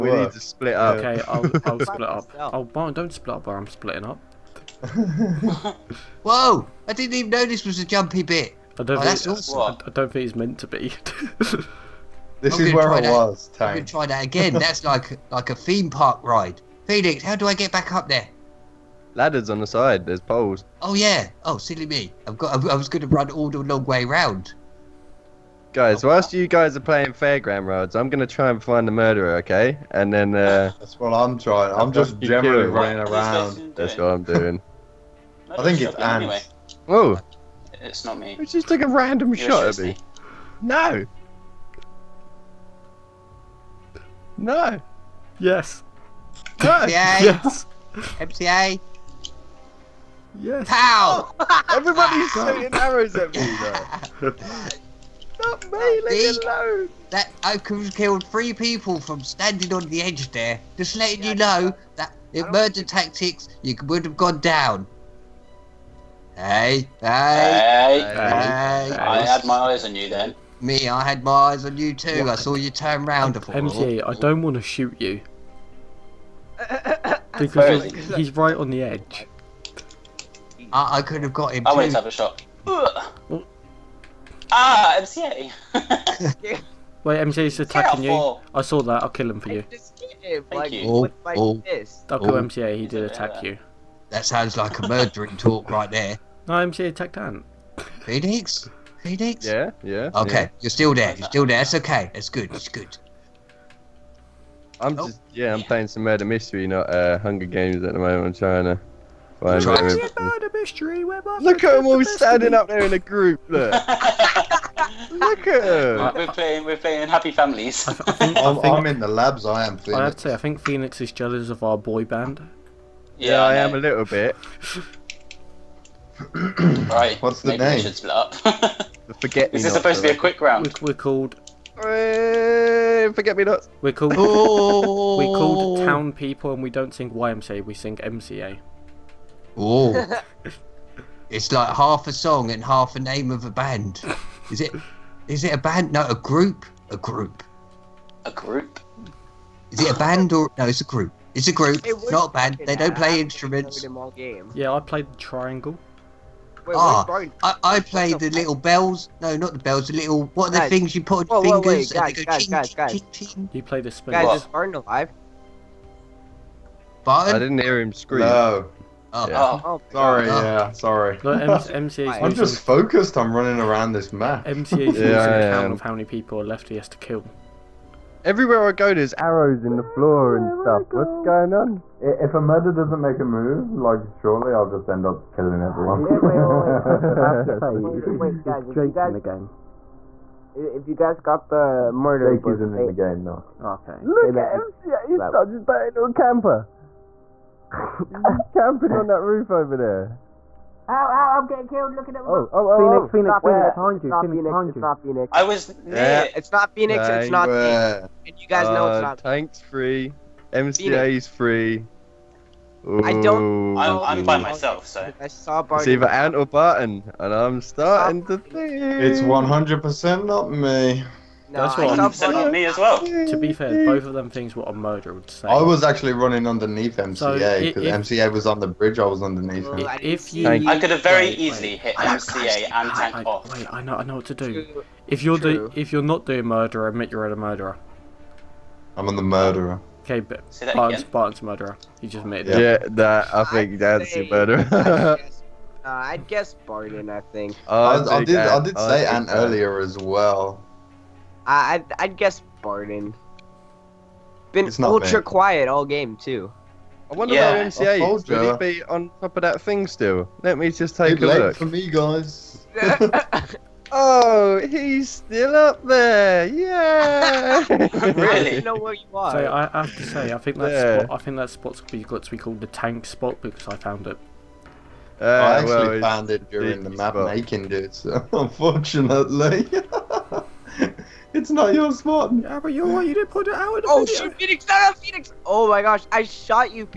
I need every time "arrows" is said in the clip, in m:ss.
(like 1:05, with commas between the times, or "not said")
0:52, 2:59.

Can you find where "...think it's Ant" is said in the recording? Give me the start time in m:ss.
0:35.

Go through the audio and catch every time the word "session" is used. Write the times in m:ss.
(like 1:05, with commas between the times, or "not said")
not said.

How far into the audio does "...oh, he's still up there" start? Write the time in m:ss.
4:23.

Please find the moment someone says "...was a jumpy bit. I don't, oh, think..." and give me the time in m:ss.
0:07.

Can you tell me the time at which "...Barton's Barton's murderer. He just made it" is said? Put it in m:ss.
4:00.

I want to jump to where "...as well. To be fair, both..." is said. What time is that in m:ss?
3:42.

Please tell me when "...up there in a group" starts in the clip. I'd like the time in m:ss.
1:52.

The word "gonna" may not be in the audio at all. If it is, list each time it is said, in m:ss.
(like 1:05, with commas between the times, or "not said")
0:13, 0:28.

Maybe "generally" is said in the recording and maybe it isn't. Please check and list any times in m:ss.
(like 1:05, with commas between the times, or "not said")
0:32.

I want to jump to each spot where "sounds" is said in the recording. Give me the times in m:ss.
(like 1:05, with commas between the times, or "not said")
1:34.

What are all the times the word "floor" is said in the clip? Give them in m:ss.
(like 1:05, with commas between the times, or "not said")
2:59.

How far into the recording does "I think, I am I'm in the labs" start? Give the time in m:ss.
1:57.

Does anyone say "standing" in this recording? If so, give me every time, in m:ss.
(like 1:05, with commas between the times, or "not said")
0:59, 1:52.